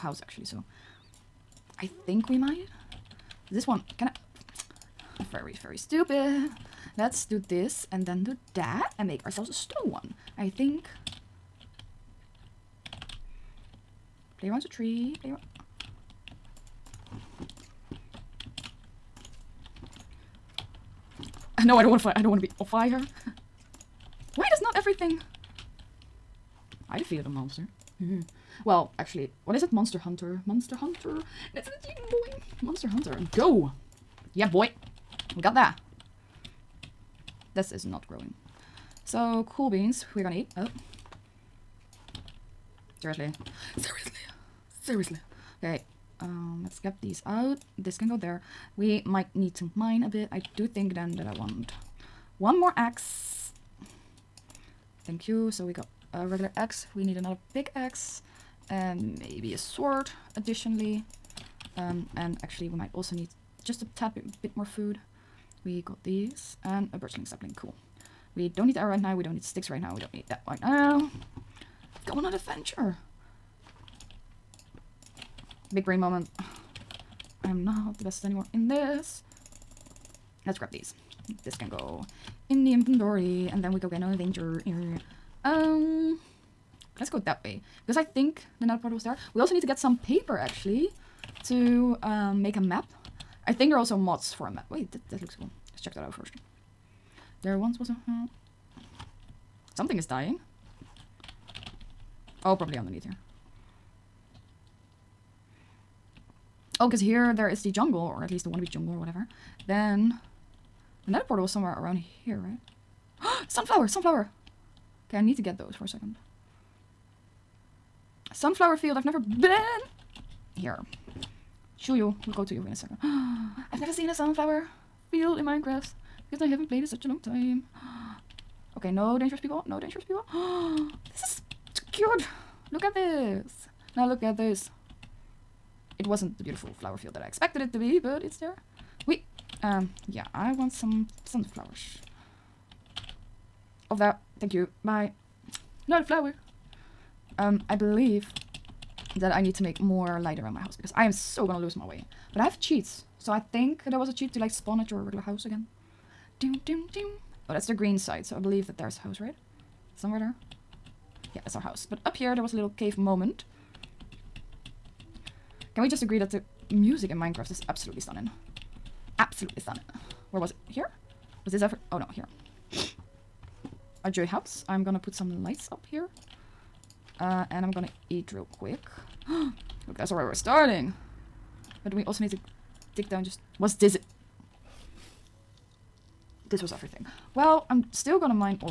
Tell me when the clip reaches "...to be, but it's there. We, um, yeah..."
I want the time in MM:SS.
02:17.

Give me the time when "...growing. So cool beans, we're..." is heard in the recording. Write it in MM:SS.
00:38.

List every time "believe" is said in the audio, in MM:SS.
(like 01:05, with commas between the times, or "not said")
02:27, 02:38.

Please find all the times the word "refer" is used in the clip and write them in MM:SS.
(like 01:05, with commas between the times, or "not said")
not said.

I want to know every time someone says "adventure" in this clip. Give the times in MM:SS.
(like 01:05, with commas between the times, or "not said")
01:12, 01:24.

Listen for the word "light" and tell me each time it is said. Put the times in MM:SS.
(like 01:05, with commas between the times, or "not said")
02:30, 02:55.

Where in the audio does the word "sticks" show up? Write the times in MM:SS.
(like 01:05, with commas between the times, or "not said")
01:09.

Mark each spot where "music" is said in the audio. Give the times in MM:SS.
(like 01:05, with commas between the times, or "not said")
02:46.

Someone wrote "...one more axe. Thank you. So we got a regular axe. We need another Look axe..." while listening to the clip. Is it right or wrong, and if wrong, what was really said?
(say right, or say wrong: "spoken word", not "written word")
wrong: "Big", not "Look".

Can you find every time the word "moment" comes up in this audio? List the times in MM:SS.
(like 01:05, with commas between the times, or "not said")
01:15, 02:42.